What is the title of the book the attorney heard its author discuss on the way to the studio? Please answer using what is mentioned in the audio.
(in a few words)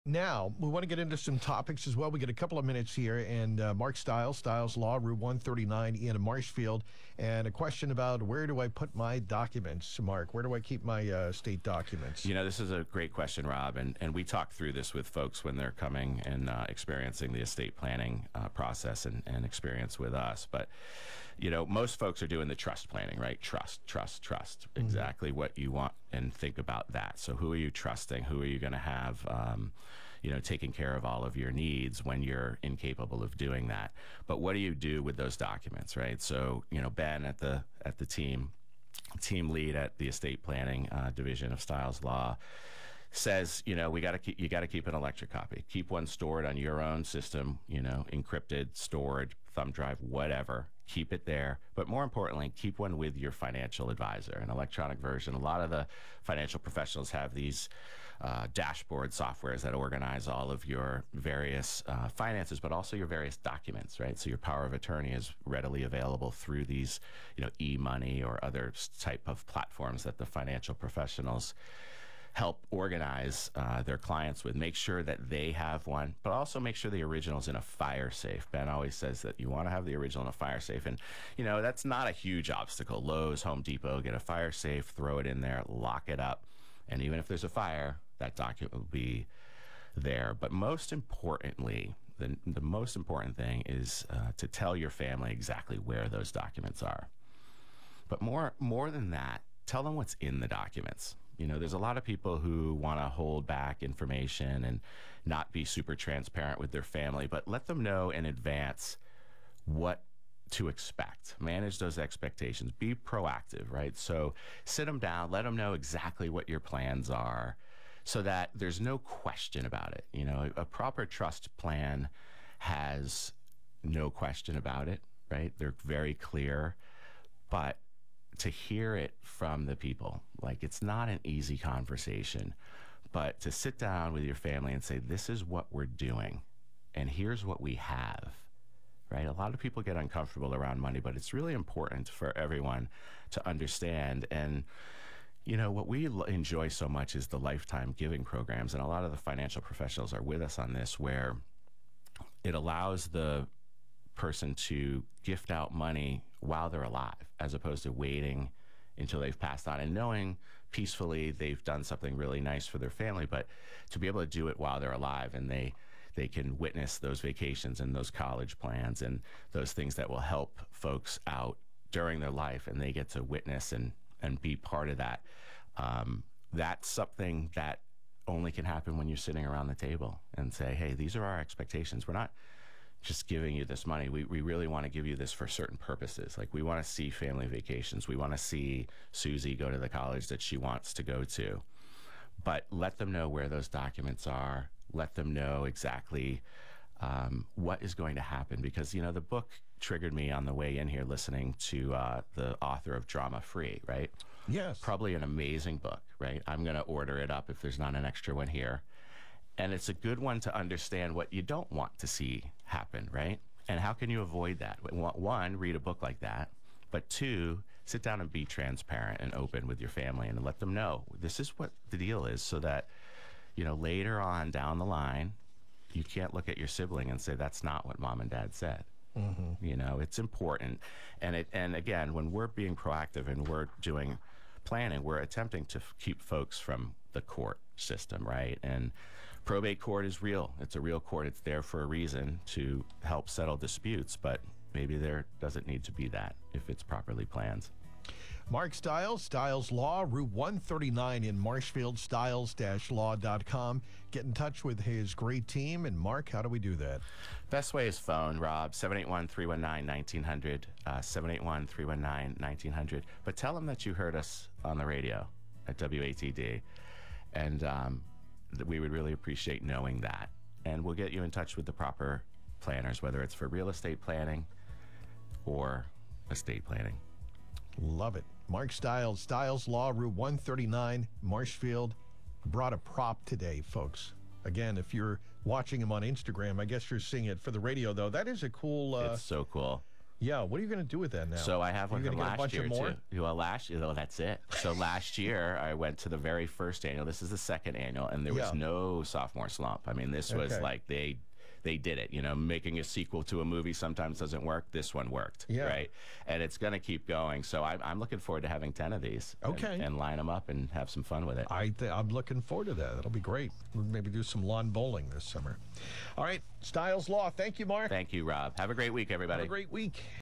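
Drama Free.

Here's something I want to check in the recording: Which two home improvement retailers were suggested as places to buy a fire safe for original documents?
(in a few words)
Lowe's, Home Depot.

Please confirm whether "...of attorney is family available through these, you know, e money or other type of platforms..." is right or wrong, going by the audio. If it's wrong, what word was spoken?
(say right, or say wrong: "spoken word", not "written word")
wrong: "readily", not "family".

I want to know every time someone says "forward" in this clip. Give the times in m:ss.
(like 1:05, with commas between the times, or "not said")
5:08, 5:12.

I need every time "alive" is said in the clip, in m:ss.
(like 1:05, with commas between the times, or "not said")
2:36, 2:44.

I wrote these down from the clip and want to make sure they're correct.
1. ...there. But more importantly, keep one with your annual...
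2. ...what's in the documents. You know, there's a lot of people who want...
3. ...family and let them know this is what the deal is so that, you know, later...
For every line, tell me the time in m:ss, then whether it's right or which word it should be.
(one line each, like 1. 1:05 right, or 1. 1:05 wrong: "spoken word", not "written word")
1. 0:51 wrong: "financial", not "annual"
2. 1:39 right
3. 3:39 right.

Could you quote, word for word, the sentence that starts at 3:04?
We, we really want to give you this for certain purposes.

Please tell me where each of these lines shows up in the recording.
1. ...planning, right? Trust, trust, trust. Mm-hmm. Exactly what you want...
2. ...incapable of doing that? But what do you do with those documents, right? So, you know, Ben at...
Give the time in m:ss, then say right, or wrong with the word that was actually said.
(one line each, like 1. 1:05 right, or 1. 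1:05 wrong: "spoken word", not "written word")
1. 0:22 right
2. 0:32 right.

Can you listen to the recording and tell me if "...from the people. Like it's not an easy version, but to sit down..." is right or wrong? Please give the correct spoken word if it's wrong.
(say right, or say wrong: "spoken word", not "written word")
wrong: "conversation", not "version".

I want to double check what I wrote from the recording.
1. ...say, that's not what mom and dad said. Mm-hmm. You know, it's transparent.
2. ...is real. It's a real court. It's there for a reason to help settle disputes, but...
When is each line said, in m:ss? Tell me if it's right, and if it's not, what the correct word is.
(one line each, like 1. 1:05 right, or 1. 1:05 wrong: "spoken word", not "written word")
1. 3:47 wrong: "important", not "transparent"
2. 4:00 right.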